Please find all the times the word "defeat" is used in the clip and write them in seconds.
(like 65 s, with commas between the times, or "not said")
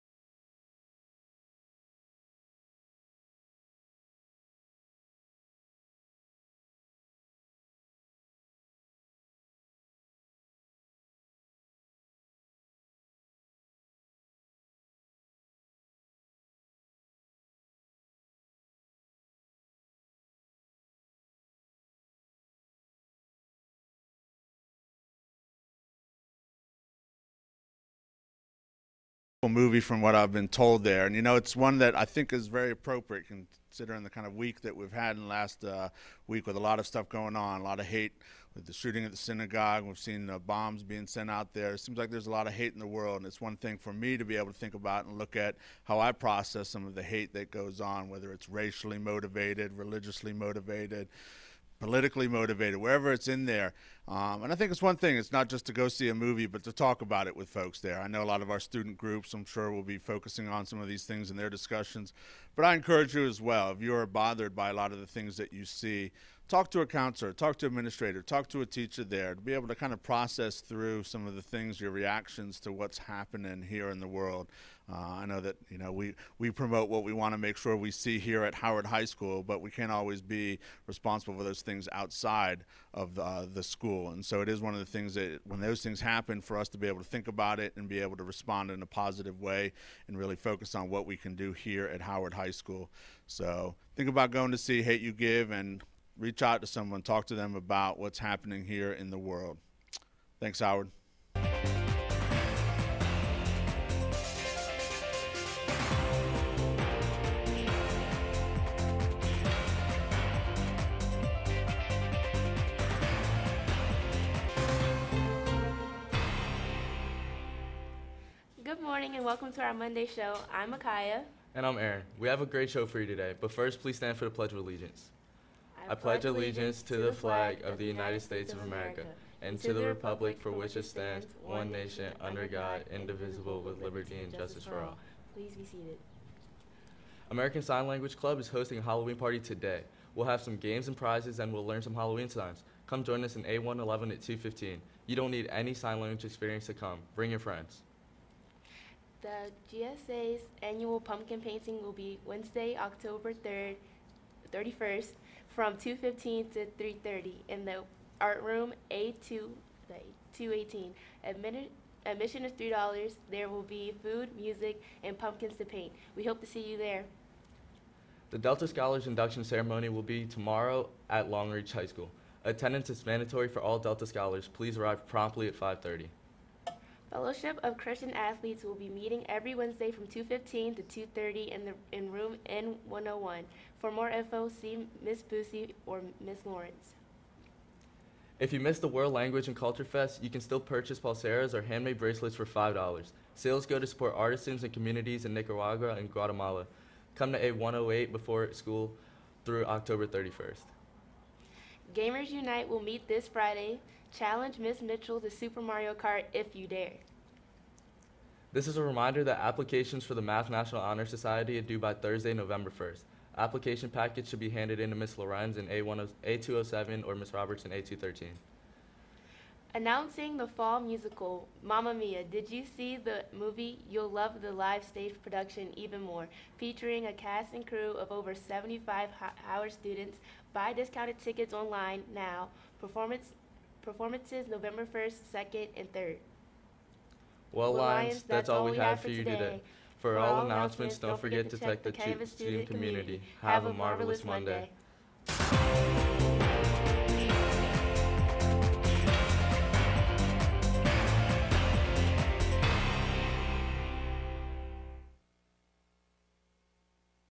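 not said.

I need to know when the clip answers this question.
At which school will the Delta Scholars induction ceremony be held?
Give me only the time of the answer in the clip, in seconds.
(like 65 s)
171 s.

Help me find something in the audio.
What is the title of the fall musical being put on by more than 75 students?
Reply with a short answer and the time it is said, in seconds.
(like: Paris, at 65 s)
Mamma Mia, at 221 s.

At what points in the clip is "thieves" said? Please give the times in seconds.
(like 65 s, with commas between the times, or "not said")
not said.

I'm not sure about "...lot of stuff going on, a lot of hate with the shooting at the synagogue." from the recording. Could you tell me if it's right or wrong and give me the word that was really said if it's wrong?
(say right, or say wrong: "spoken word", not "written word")
right.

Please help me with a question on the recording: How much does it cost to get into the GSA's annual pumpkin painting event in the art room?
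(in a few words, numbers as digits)
$3.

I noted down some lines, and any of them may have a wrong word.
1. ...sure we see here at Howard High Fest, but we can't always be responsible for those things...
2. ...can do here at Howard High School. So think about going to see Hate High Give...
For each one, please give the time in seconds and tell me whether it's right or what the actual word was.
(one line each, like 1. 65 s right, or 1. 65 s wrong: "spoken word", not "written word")
1. 77 s wrong: "School", not "Fest"
2. 91 s wrong: "You", not "High".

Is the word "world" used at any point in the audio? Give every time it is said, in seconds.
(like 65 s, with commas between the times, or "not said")
42 s, 74 s, 99 s, 188 s.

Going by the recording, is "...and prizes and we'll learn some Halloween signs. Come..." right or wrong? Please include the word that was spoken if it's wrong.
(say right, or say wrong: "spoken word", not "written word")
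right.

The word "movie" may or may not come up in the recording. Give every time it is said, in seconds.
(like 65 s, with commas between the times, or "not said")
29 s, 56 s, 223 s.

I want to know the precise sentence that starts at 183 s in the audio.
For more info, see Miss Boosie or Miss Lawrence.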